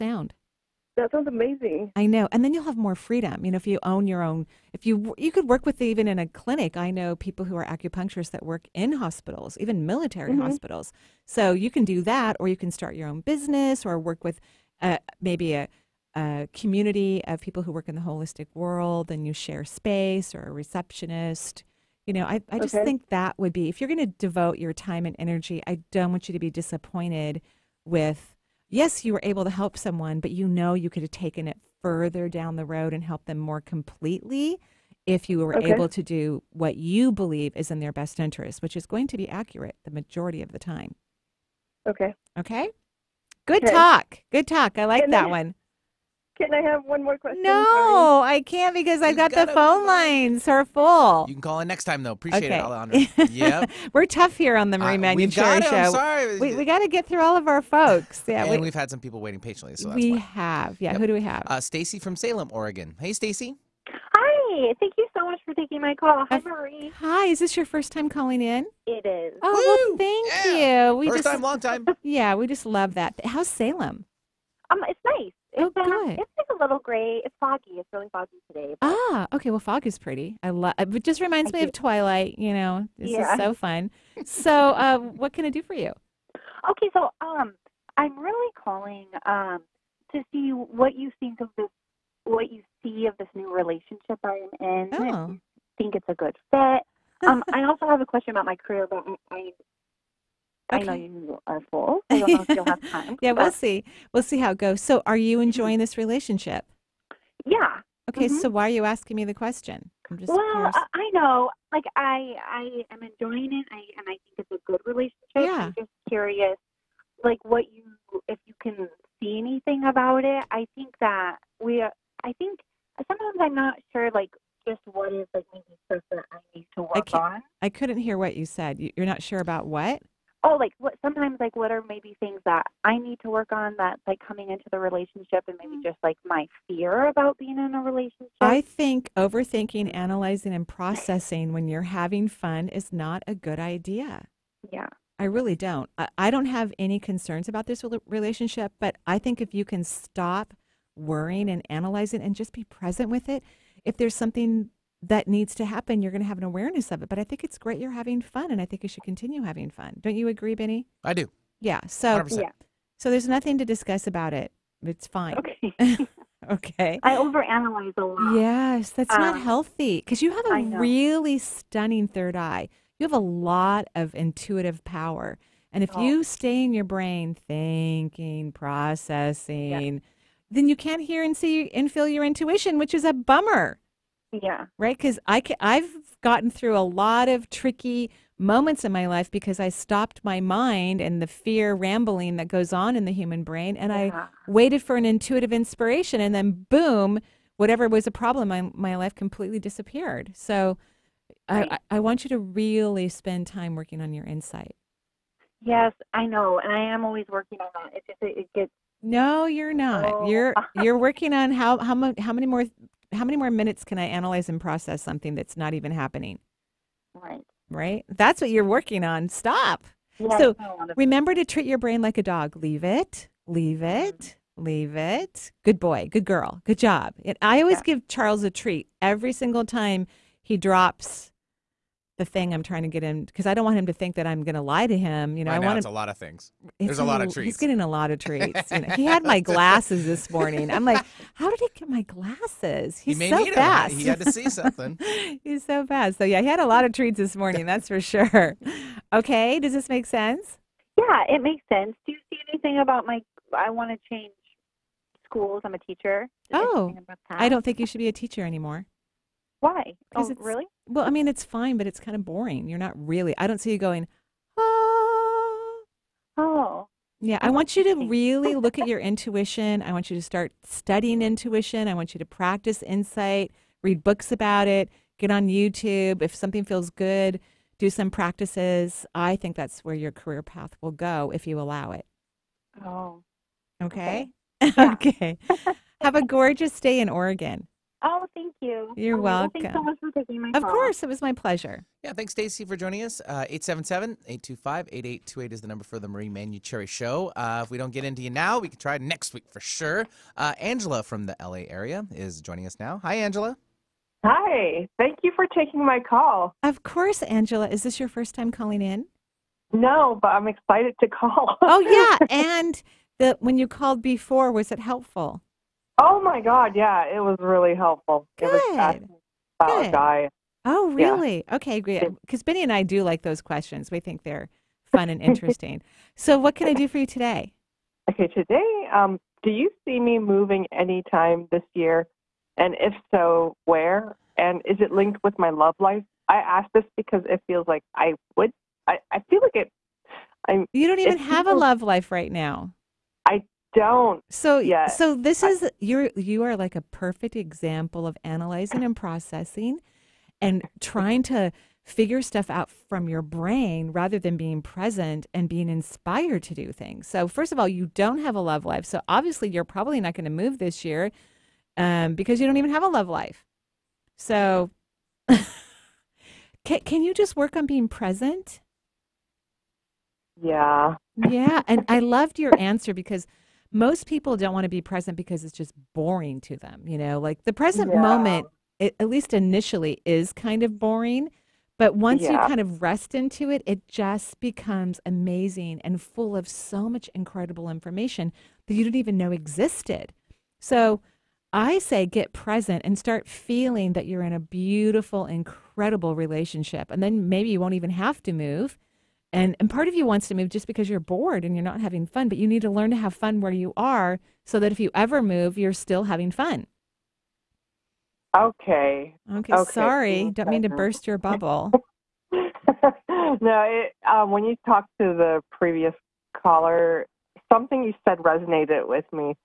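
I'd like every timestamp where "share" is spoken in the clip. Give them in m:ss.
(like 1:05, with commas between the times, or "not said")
0:19.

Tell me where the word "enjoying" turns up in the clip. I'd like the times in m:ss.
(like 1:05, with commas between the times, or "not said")
1:45, 1:53.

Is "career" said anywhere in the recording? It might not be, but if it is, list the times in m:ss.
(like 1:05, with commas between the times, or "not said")
1:38, 4:40.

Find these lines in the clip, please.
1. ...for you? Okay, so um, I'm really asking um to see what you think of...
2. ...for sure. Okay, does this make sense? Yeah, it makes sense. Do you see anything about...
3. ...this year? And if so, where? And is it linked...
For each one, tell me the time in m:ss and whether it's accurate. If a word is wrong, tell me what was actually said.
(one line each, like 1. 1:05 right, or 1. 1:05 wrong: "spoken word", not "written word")
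1. 1:25 wrong: "calling", not "asking"
2. 4:07 right
3. 5:31 right.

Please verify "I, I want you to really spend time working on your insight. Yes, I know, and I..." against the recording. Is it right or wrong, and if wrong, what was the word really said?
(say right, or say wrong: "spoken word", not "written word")
right.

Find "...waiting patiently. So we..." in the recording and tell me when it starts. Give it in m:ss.
0:59.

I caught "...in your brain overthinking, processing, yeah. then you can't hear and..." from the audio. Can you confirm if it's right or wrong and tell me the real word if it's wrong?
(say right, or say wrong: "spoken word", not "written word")
wrong: "thinking", not "overthinking".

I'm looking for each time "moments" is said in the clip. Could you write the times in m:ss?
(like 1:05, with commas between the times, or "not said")
3:08, 6:18.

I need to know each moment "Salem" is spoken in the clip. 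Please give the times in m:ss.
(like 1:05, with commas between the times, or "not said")
1:02, 1:13.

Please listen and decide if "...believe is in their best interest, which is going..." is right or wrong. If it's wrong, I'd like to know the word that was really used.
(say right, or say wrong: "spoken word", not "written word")
right.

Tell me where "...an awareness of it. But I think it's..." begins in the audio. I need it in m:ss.
2:36.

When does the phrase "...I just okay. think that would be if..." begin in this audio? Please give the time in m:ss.
0:22.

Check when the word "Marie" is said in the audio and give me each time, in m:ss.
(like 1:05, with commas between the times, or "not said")
0:54, 1:06, 4:56.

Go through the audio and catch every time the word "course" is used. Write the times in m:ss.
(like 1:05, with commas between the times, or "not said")
4:50, 5:06.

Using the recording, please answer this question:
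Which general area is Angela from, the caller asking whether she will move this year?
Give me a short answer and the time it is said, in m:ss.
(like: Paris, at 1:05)
LA area, at 5:01.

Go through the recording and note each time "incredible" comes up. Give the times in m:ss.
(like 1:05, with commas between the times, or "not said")
6:27, 6:35.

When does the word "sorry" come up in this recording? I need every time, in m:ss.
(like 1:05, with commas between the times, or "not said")
0:47, 0:55, 6:49.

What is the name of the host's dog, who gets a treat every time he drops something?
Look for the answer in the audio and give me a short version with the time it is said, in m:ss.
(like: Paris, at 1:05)
Charles, at 3:48.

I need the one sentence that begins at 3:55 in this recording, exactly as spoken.
You know, right I want want it's a lot of things.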